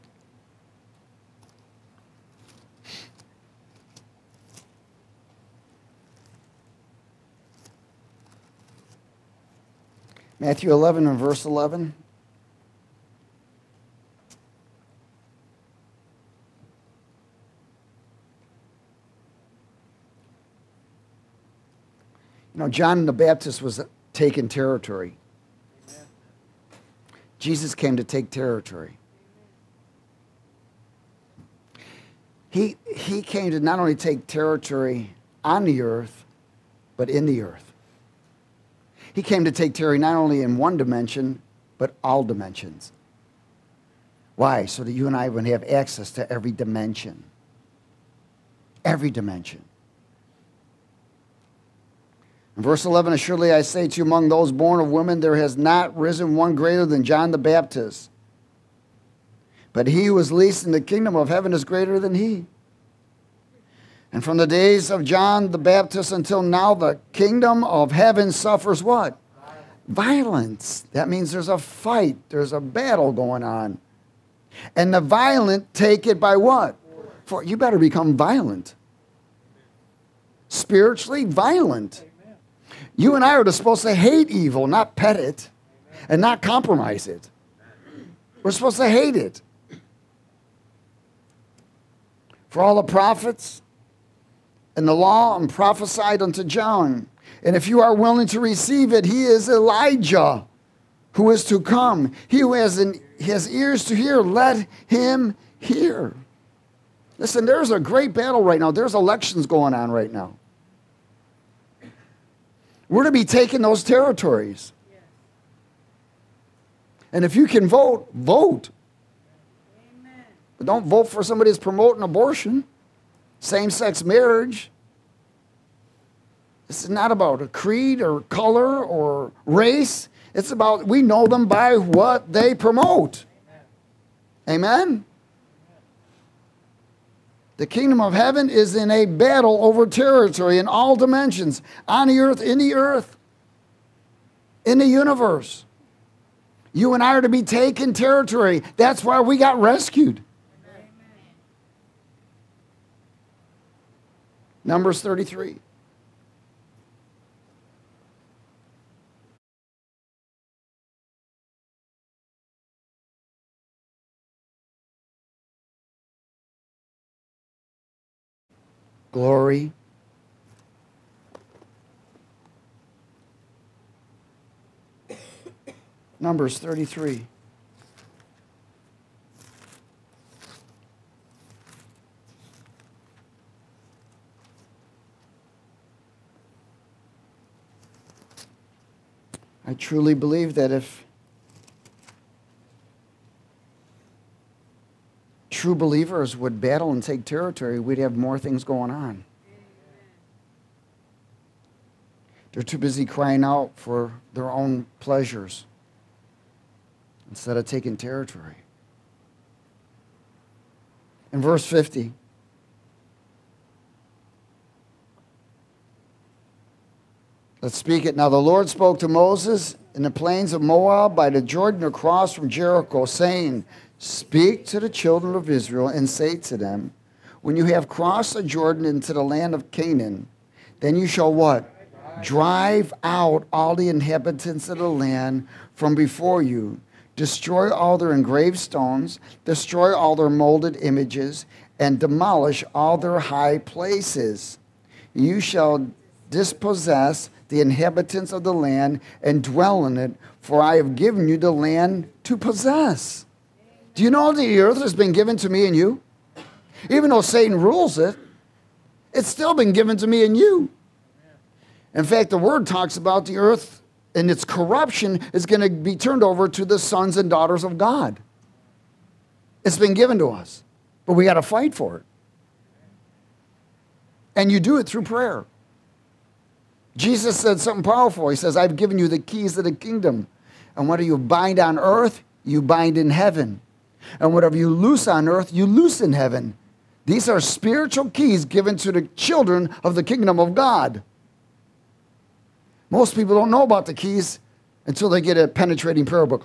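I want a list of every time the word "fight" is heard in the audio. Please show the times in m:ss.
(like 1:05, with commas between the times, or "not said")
1:11, 4:31.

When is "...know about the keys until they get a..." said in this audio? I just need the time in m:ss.
4:53.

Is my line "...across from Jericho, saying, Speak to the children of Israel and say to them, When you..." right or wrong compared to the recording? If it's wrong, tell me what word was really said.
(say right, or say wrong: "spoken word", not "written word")
right.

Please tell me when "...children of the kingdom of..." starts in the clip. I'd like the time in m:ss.
4:49.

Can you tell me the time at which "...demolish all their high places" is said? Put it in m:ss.
4:01.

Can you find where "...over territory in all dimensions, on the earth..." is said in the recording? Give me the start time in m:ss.
2:19.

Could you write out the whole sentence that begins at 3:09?
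truly believe that if true believers would battle and take territory, we'd have more things going on.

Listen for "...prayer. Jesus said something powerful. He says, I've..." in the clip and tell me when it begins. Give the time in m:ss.
4:35.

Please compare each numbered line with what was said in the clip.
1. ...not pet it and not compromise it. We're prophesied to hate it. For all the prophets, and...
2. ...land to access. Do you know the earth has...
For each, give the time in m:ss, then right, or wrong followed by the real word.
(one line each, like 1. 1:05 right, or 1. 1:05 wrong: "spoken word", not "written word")
1. 1:24 wrong: "supposed", not "prophesied"
2. 4:11 wrong: "possess", not "access".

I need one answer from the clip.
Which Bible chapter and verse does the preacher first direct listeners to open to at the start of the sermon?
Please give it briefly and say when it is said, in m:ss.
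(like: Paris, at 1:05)
Matthew 11:11, at 0:10.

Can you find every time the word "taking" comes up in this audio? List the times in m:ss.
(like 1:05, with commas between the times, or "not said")
0:24, 1:53, 2:27, 3:27.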